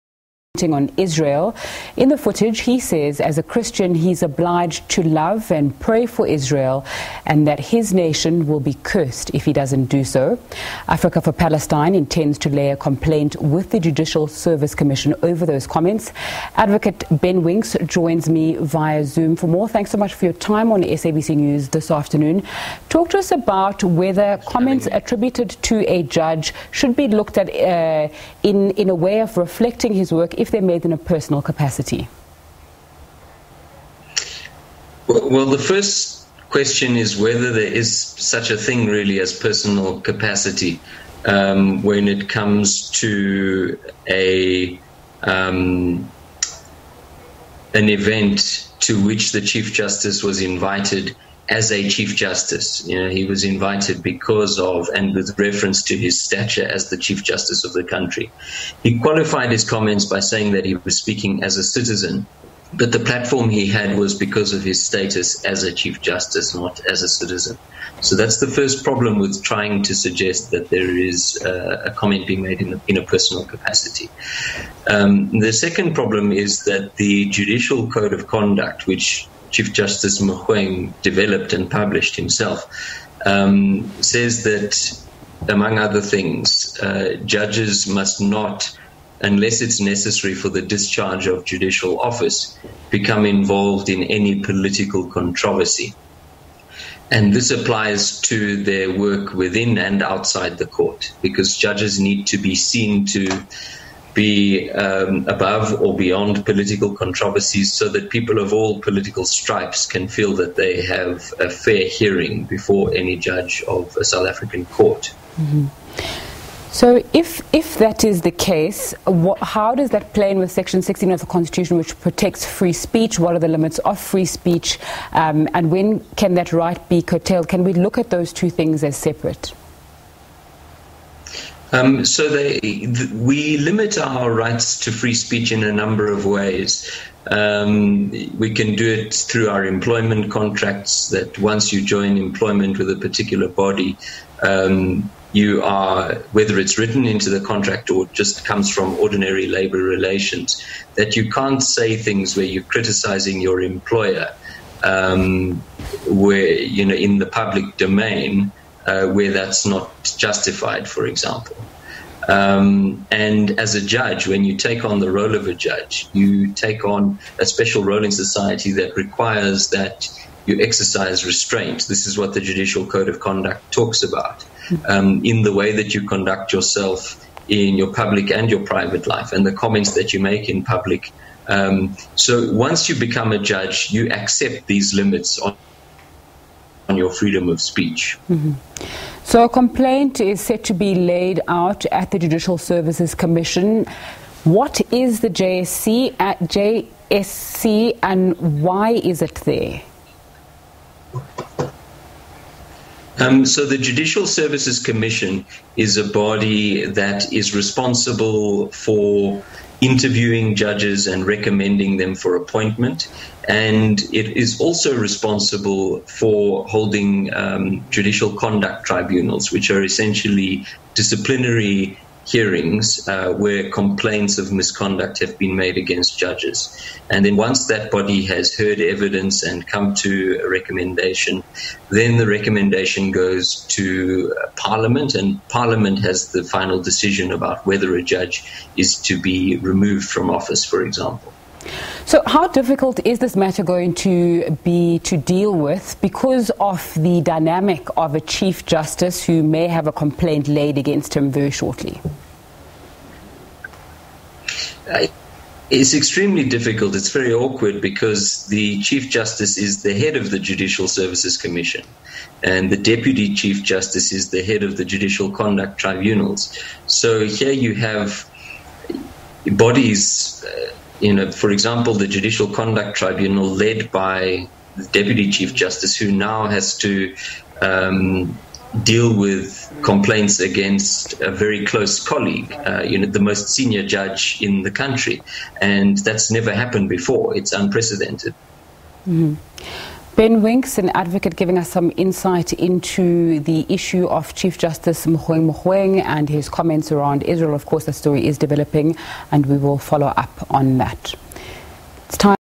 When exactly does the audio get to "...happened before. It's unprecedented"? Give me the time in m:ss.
4:46.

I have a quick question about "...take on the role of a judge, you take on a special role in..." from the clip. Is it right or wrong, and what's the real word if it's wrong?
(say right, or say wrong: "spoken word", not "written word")
right.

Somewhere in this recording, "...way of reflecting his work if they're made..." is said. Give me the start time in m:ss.
0:28.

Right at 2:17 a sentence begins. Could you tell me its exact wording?
Um, we can do it through our employment contracts.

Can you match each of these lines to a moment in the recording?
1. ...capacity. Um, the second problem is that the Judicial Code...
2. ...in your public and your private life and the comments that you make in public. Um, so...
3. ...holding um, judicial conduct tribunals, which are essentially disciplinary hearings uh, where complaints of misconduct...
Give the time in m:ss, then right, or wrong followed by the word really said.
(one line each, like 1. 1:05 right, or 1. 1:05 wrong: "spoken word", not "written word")
1. 1:13 right
2. 2:57 right
3. 3:36 right.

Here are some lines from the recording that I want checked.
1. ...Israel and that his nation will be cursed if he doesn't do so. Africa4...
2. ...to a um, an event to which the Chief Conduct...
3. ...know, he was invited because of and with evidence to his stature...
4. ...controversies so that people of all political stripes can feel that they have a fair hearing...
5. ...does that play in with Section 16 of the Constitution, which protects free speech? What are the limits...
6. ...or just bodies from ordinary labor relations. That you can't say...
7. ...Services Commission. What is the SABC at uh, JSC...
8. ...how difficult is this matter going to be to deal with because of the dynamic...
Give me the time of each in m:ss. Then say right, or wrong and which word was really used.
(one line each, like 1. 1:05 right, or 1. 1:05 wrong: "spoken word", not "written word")
1. 0:06 right
2. 0:43 wrong: "Justice", not "Conduct"
3. 0:53 wrong: "reference", not "evidence"
4. 1:46 right
5. 1:59 right
6. 2:27 wrong: "comes", not "bodies"
7. 3:12 wrong: "JSC", not "SABC"
8. 4:02 right.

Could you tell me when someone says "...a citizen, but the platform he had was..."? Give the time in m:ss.
1:01.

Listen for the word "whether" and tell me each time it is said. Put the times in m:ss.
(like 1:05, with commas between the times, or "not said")
0:23, 0:37, 2:26, 3:57.